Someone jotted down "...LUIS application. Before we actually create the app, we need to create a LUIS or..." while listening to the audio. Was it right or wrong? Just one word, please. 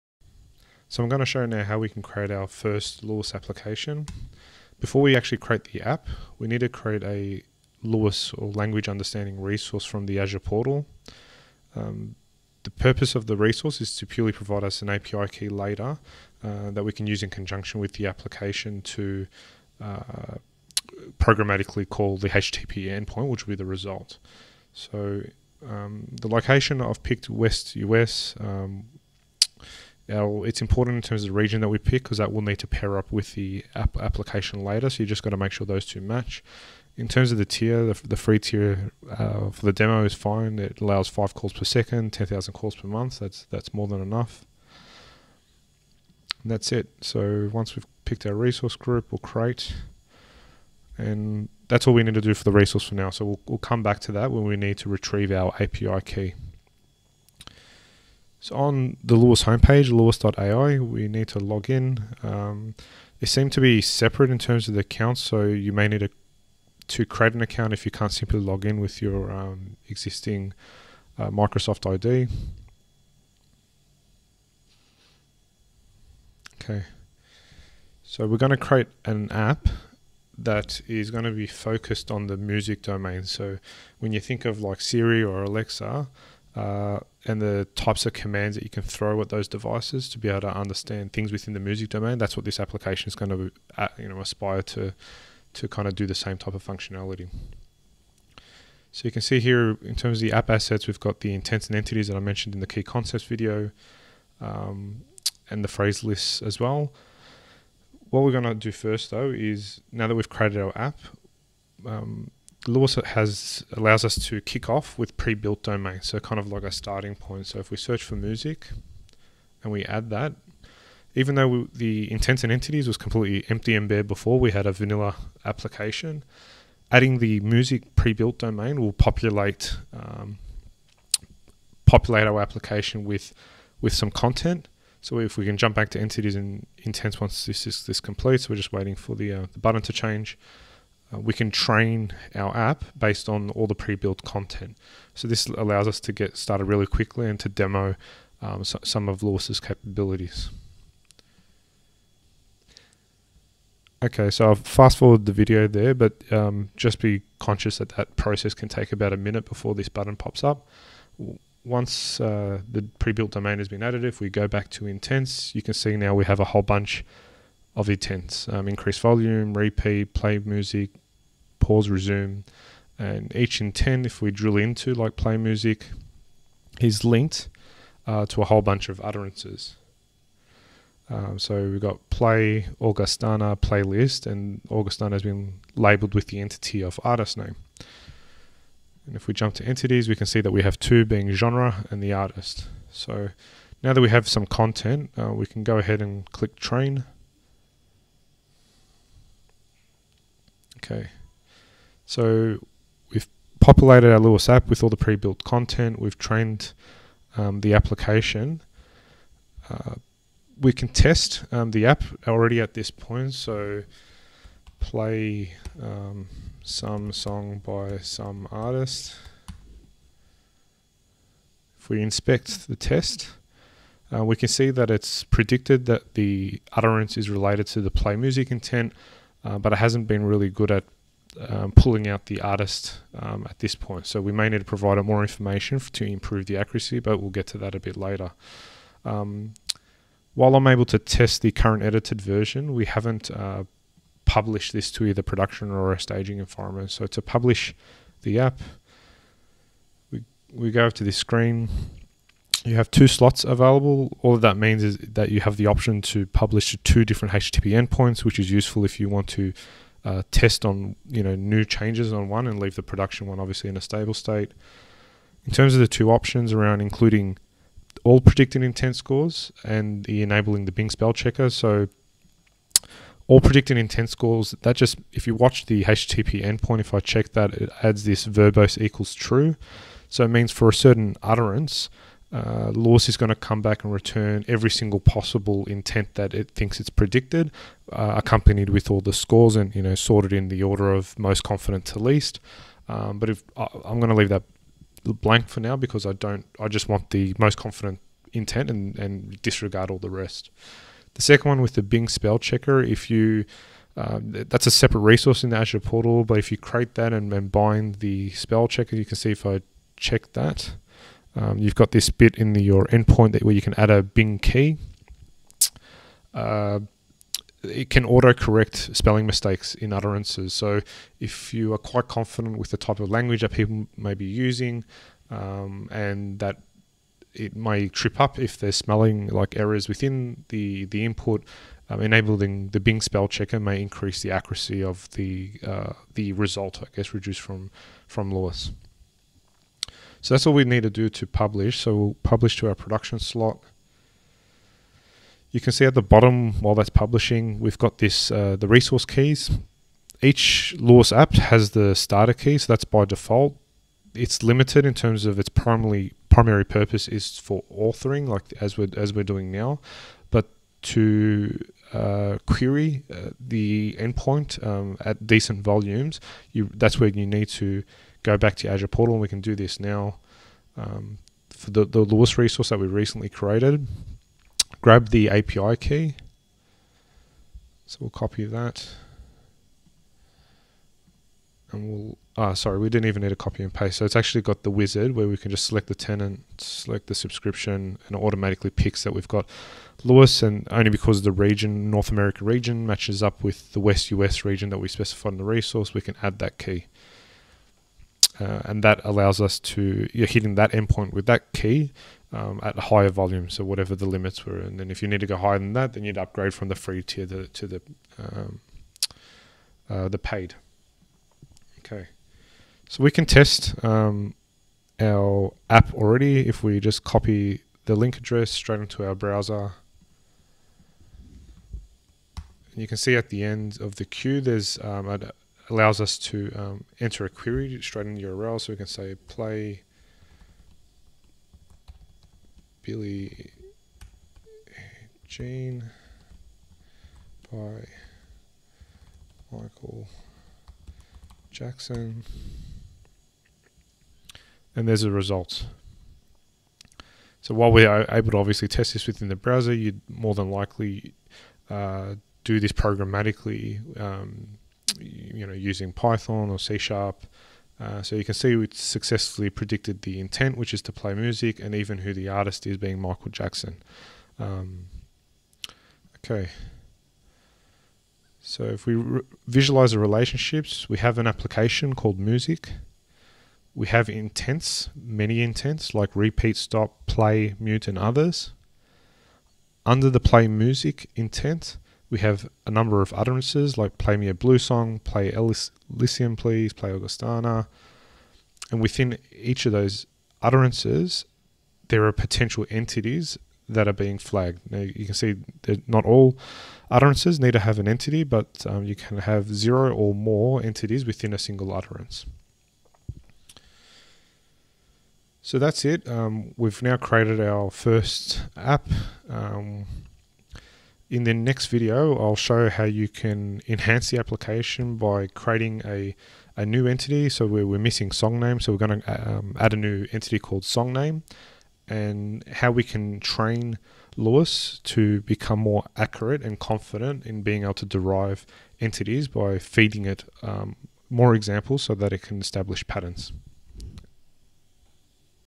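right.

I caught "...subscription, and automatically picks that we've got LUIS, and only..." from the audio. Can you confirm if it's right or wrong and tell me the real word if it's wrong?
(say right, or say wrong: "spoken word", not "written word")
right.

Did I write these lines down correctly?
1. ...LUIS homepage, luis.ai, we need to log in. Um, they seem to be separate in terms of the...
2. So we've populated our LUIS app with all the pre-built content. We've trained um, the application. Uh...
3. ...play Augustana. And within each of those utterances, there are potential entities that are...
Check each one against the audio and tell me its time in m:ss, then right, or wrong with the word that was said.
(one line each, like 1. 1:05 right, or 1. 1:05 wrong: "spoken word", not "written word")
1. 0:59 right
2. 3:22 right
3. 8:06 right.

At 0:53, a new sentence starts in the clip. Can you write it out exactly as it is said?
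So we'll, we'll come back to that when we need to retrieve our API key.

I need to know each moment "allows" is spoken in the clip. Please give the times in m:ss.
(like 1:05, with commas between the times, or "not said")
0:40, 1:53, 2:25, 6:39, 7:05.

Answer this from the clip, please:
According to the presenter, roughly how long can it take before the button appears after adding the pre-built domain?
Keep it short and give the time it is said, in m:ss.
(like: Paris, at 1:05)
About a minute, at 2:38.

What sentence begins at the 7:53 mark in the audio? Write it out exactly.
We have intents, many intents, like repeat, stop, play, mute, and others.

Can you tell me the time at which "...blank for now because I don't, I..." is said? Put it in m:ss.
4:55.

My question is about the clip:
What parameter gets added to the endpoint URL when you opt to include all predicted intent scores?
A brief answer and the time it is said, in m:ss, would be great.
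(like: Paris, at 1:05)
verbose equals true, at 4:38.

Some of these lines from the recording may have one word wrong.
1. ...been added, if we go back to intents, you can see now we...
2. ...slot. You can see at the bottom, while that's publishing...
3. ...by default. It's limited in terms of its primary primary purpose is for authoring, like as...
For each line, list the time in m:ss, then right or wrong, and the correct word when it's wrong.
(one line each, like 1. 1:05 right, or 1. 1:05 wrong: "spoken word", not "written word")
1. 2:43 right
2. 5:43 right
3. 5:52 right.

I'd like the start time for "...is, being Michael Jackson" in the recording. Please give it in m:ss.
7:42.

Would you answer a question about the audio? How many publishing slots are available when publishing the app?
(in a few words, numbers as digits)
2.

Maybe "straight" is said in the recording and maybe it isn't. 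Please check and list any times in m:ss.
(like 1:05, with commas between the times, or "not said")
6:58, 7:07.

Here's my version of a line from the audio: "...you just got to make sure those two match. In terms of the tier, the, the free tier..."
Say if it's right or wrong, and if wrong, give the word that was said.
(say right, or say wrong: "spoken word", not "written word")
right.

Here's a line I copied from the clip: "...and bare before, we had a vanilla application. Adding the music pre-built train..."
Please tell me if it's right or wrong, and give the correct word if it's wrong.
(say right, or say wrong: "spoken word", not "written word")
wrong: "domain", not "train".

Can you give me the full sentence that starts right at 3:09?
And if we jump to entities, we can see that we have two being genre and the artist.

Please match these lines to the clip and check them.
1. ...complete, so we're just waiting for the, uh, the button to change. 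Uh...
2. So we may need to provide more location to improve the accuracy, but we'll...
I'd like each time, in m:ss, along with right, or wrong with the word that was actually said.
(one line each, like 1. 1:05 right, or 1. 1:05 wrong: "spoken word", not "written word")
1. 2:17 right
2. 3:54 wrong: "information", not "location".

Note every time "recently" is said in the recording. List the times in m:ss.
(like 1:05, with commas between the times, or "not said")
6:12.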